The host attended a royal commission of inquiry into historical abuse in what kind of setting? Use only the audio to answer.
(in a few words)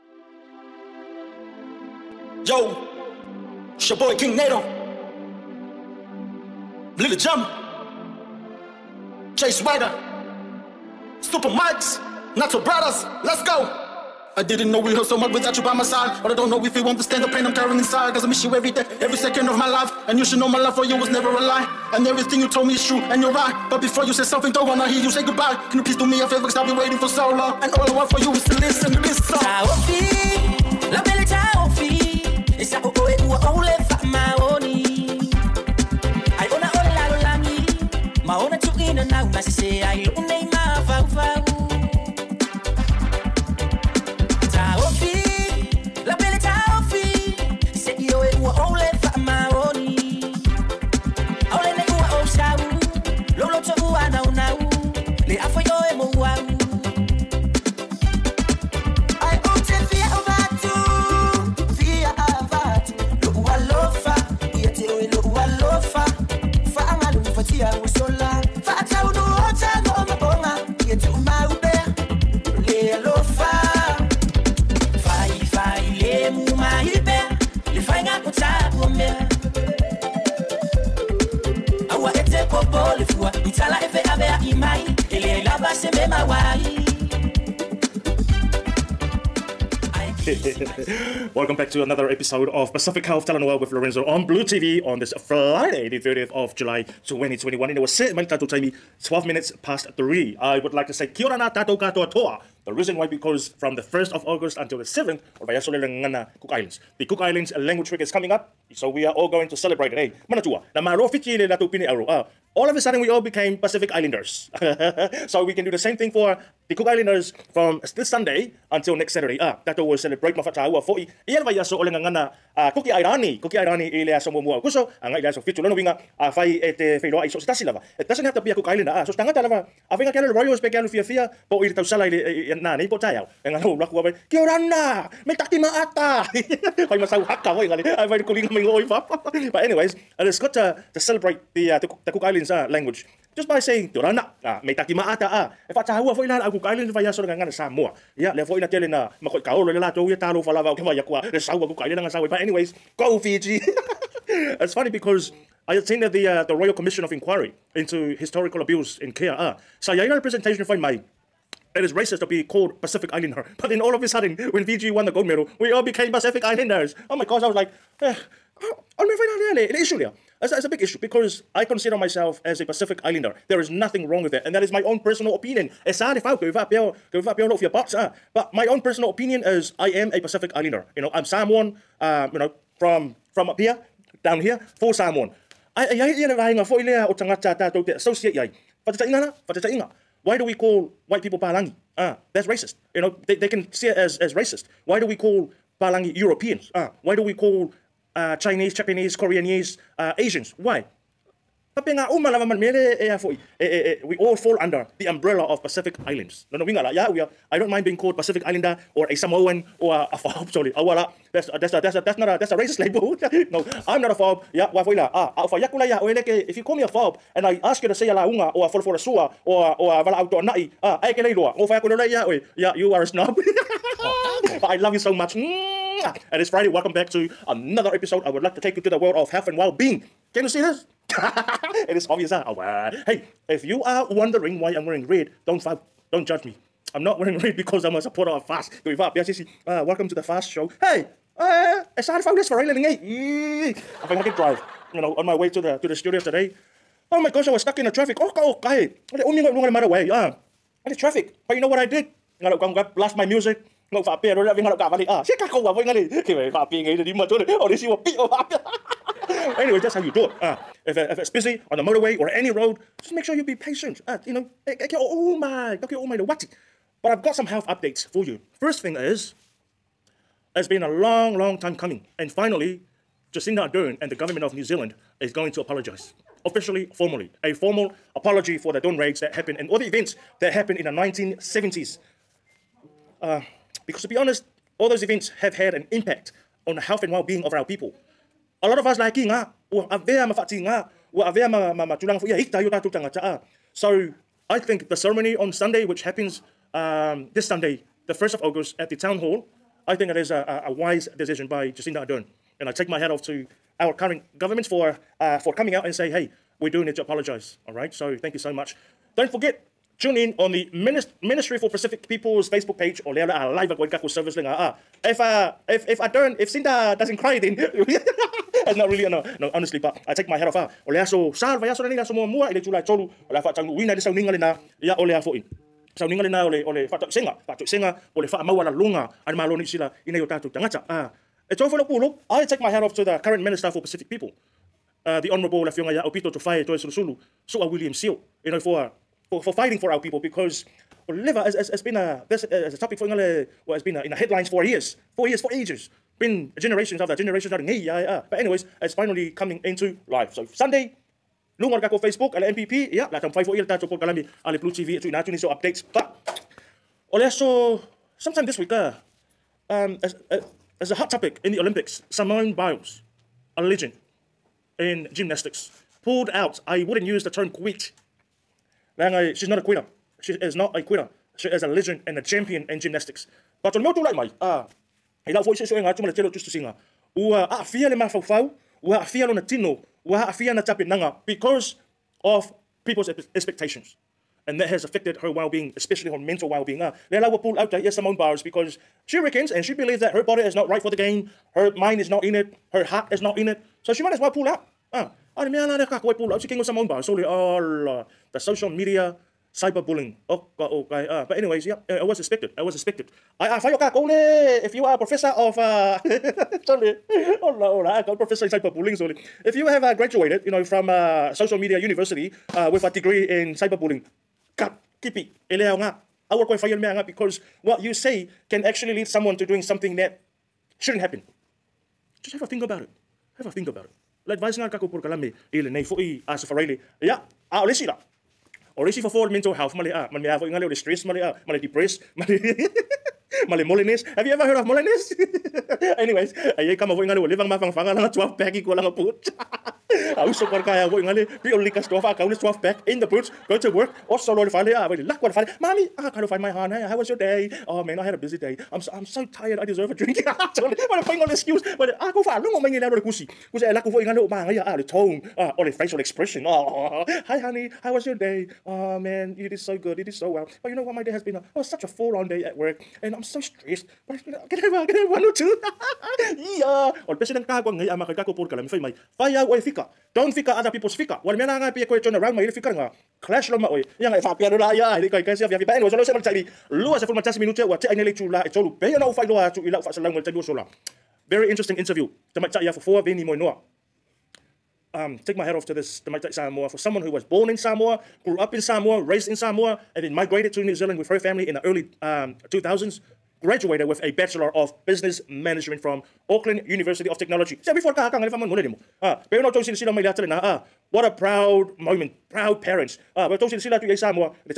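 in care.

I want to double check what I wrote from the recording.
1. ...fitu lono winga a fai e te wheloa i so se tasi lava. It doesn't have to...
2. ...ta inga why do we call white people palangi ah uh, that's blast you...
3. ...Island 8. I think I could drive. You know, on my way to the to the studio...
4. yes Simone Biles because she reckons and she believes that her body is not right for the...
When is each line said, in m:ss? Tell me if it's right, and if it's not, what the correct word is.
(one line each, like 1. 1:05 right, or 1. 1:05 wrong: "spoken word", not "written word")
1. 2:05 right
2. 3:09 wrong: "racist", not "blast"
3. 4:02 right
4. 6:27 right.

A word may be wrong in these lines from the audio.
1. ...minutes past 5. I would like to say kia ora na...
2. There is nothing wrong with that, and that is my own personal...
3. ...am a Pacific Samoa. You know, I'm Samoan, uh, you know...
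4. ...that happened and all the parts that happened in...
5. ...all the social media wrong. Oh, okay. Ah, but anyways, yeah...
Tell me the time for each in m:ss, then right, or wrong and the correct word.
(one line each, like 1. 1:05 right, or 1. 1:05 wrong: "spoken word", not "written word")
1. 1:39 wrong: "3", not "5"
2. 2:53 right
3. 2:59 wrong: "Islander", not "Samoa"
4. 4:39 wrong: "events", not "parts"
5. 6:37 wrong: "cyberbullying", not "wrong".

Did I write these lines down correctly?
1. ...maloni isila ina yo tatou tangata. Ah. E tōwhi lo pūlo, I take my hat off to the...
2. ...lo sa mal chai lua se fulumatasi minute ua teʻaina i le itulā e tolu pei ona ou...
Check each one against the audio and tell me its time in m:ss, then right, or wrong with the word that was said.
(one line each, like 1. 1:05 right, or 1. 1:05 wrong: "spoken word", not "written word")
1. 5:29 right
2. 7:55 right.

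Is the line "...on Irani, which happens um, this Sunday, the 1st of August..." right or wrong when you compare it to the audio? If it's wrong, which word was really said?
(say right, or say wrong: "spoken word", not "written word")
wrong: "Sunday", not "Irani".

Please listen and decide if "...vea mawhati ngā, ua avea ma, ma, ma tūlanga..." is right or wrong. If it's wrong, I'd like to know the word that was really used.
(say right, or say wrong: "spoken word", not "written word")
right.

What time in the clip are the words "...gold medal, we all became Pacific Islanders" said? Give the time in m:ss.
2:45.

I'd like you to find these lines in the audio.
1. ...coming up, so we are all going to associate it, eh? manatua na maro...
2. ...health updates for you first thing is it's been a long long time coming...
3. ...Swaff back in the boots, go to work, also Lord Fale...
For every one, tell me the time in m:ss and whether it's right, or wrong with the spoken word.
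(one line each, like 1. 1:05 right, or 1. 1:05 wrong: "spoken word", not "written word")
1. 1:48 wrong: "celebrate", not "associate"
2. 4:27 right
3. 7:22 right.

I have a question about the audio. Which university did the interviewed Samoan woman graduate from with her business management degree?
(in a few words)
Auckland University of Technology.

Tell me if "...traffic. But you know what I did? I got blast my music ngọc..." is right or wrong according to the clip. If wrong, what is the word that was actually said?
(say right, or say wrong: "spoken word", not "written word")
right.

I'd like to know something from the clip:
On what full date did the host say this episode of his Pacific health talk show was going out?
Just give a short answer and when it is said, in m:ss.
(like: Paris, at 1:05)
30th of July 2021, at 1:35.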